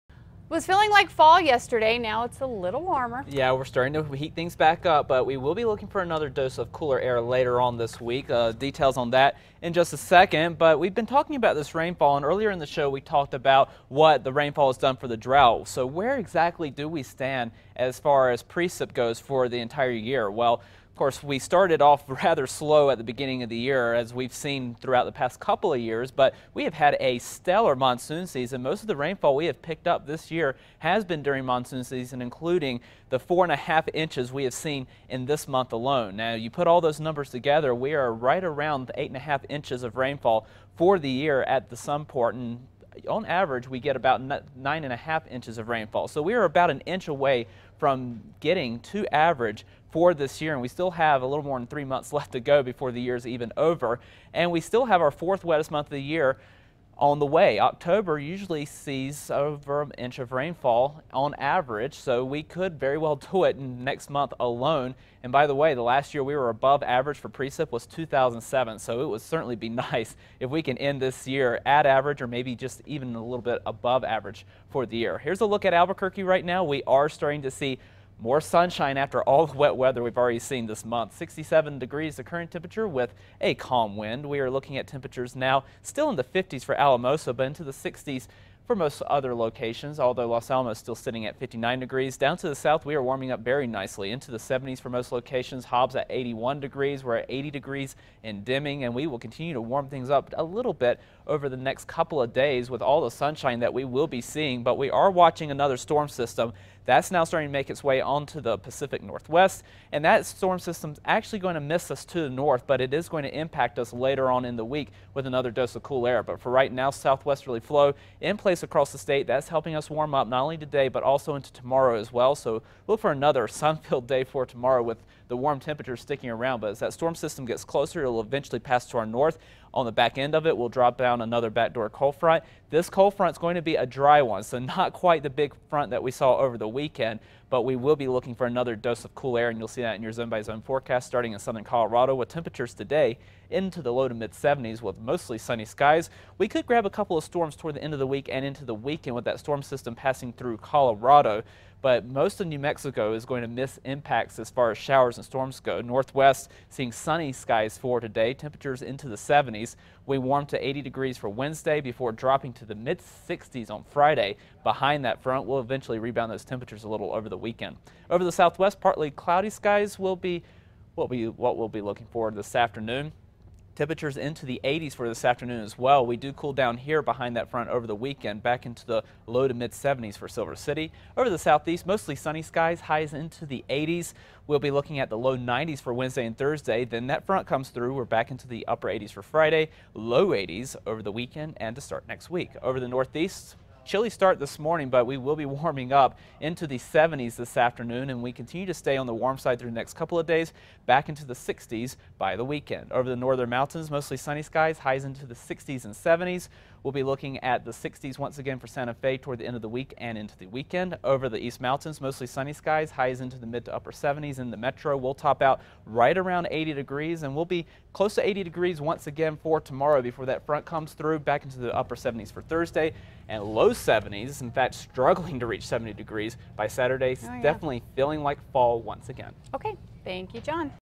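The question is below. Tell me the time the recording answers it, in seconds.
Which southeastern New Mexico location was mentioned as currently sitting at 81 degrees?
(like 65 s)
95 s.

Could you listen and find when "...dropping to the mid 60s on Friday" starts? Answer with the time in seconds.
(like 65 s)
162 s.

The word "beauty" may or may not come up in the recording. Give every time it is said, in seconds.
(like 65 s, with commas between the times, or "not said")
not said.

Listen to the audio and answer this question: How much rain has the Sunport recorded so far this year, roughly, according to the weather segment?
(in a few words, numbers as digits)
8.5 inches.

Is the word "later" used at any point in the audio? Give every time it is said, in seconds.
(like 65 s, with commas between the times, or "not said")
7 s, 113 s.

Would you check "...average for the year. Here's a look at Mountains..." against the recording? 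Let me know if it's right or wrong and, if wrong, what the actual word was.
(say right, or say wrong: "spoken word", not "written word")
wrong: "Albuquerque", not "Mountains".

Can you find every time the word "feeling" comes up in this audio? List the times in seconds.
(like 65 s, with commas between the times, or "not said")
0 s, 227 s.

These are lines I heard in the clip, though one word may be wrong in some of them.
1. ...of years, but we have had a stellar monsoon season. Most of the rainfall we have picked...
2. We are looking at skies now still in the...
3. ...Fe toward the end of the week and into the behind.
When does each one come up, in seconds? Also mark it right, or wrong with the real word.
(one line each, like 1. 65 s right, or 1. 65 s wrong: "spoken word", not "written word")
1. 25 s right
2. 84 s wrong: "temperatures", not "skies"
3. 208 s wrong: "weekend", not "behind".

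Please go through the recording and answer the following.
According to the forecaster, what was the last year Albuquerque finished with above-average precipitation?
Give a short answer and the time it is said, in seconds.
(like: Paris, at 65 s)
2007, at 67 s.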